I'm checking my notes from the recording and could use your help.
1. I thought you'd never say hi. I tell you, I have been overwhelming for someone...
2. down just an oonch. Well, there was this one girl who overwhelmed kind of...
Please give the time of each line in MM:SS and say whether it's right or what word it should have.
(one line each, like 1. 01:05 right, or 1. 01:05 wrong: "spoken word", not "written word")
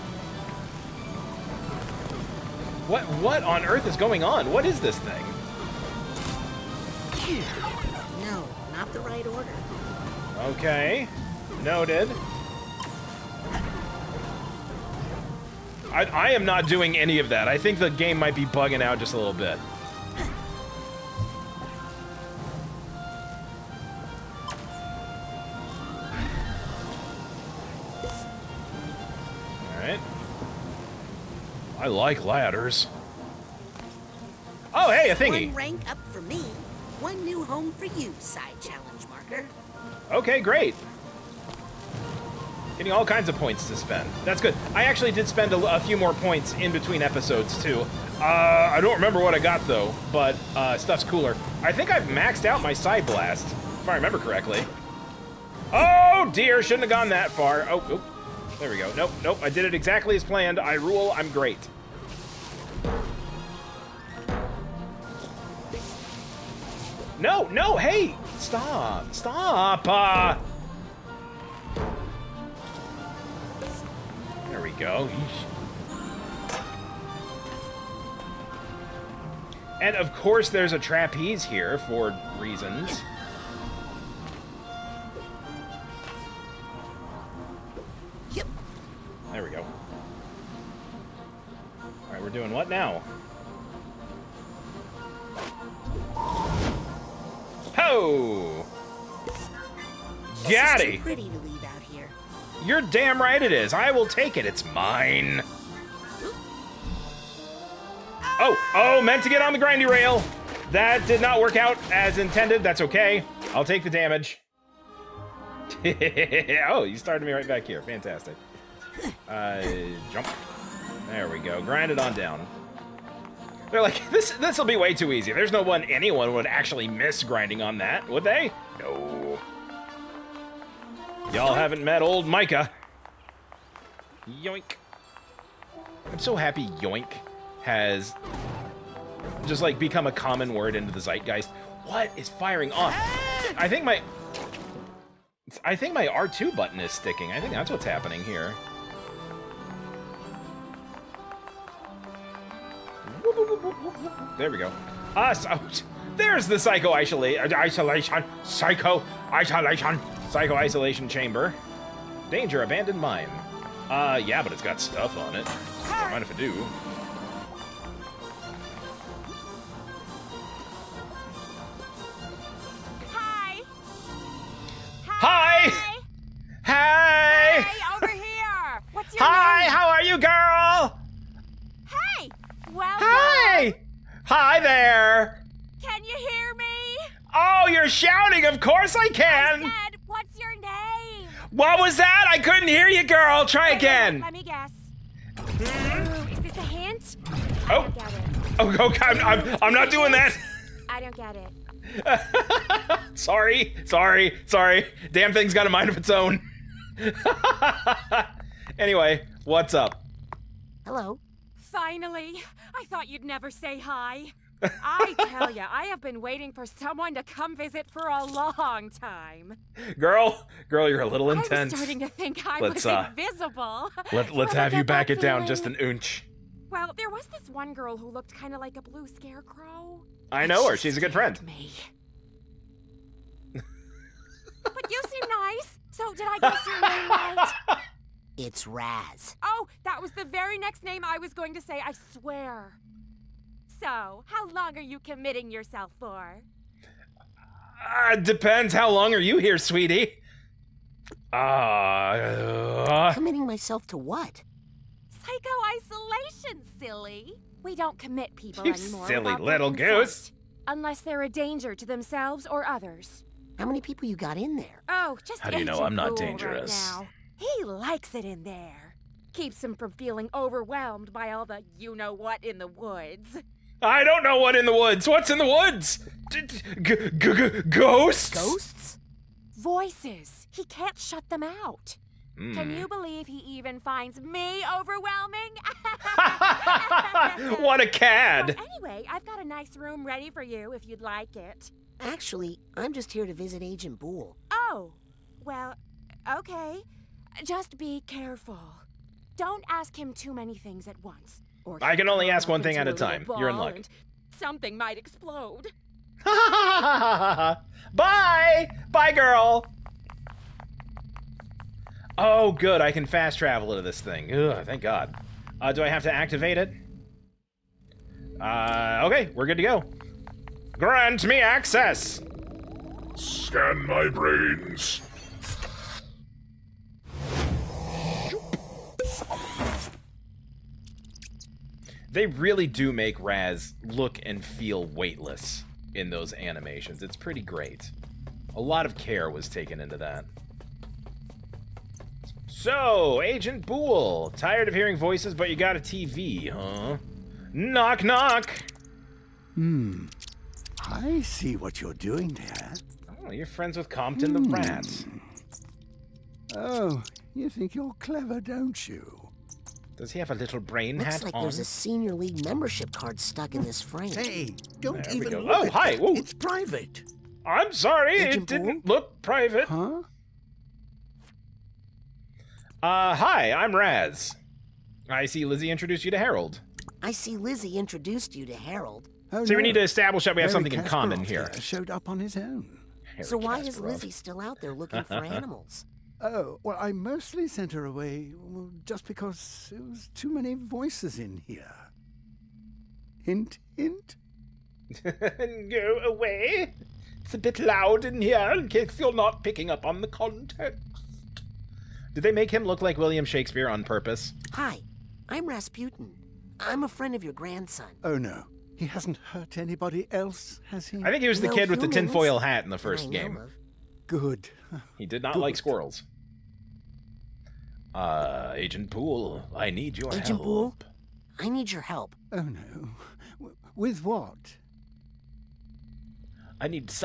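1. 03:32 wrong: "waiting", not "overwhelming"
2. 03:45 wrong: "looked", not "overwhelmed".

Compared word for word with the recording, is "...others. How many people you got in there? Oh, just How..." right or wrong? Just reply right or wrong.
right.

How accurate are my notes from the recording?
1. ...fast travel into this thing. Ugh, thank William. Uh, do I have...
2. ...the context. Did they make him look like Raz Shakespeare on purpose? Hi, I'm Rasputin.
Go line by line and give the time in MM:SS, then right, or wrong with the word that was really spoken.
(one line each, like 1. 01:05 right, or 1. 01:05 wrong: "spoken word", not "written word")
1. 05:13 wrong: "God", not "William"
2. 06:40 wrong: "William", not "Raz".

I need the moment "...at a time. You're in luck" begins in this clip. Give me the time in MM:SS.
05:02.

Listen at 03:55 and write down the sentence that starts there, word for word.
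So did I guess your name right?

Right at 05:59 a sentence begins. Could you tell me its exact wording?
Does he have a little brain Looks hat like on?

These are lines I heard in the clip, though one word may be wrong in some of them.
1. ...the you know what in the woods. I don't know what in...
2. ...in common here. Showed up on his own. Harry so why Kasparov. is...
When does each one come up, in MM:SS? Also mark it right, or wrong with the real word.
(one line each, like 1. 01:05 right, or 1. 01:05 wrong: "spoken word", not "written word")
1. 04:31 right
2. 06:20 right.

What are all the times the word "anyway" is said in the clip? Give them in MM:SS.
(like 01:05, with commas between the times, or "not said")
03:28, 04:48.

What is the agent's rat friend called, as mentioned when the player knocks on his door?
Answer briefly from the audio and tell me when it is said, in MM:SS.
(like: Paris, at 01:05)
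Compton, at 05:53.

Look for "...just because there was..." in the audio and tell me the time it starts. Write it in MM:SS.
06:28.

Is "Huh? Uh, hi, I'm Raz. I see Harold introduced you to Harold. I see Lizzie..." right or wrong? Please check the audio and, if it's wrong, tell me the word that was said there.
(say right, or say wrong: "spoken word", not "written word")
wrong: "Lizzie", not "Harold".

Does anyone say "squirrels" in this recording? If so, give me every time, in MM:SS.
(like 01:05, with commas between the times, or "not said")
06:55.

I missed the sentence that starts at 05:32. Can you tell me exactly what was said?
they really do make Raz look and feel weightless in those animations.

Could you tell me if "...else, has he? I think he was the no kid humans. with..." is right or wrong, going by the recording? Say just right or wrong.
right.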